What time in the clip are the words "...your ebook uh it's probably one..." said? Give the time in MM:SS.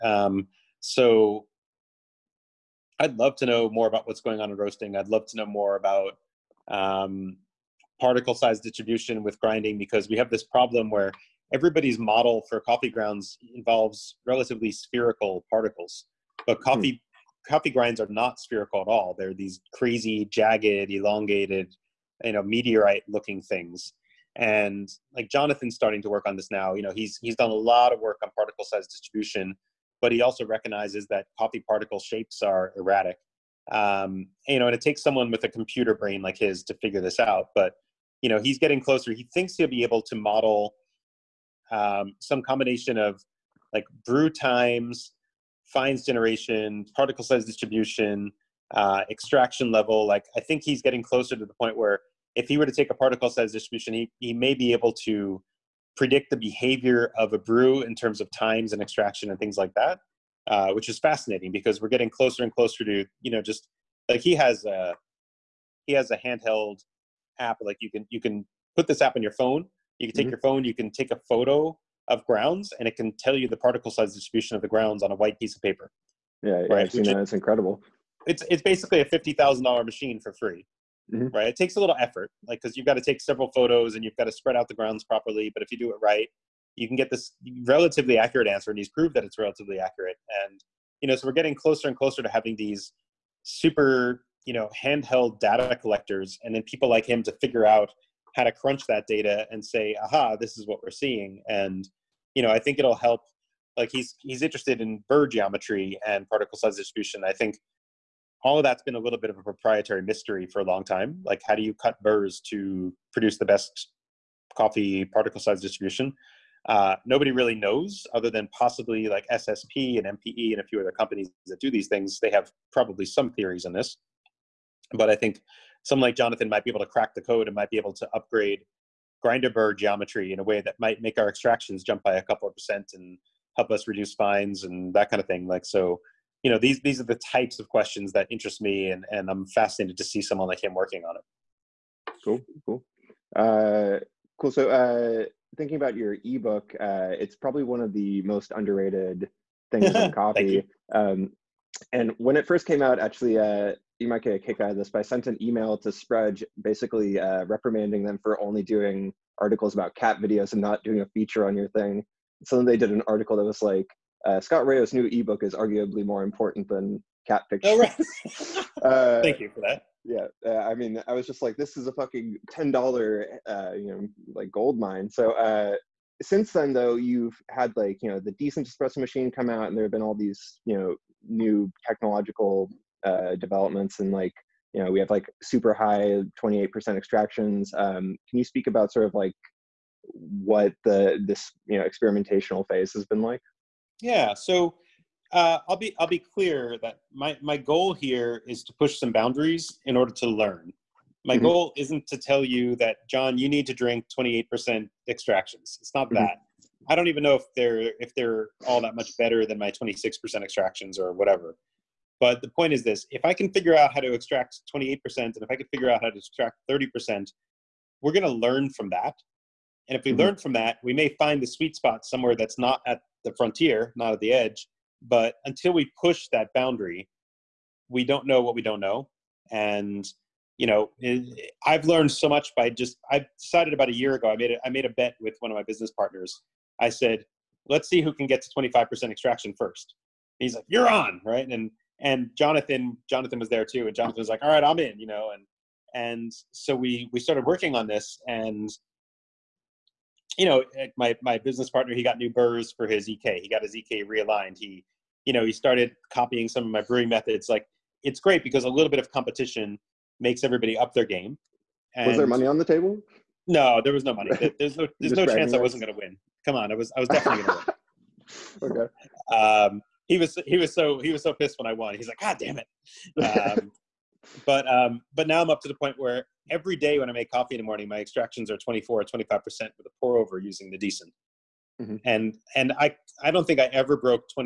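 02:25.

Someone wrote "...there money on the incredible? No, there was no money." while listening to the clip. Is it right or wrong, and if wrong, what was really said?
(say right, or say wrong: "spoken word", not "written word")
wrong: "table", not "incredible".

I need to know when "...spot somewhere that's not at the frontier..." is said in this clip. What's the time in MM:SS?
03:41.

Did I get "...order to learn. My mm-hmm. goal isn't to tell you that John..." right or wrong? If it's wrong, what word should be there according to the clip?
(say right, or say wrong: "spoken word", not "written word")
right.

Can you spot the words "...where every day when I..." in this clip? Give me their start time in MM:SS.
04:35.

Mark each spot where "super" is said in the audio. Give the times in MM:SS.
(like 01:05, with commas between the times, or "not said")
01:33, 03:05.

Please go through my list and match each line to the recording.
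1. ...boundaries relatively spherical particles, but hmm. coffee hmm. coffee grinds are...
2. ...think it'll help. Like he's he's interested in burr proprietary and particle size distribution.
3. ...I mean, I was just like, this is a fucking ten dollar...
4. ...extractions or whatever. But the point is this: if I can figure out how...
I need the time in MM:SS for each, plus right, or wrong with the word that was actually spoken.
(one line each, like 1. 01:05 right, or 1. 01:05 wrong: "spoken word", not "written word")
1. 00:13 wrong: "involves", not "boundaries"
2. 01:42 wrong: "geometry", not "proprietary"
3. 02:50 right
4. 03:30 right.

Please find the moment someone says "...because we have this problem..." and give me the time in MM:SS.
00:09.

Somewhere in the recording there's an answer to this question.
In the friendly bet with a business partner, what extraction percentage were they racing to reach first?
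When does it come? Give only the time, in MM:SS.
03:58.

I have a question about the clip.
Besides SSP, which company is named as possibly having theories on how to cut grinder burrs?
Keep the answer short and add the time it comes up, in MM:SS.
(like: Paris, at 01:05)
MPE, at 02:00.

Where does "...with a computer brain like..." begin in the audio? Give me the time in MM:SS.
00:35.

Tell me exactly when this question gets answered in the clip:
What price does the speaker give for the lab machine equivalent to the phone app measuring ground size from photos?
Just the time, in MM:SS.
01:19.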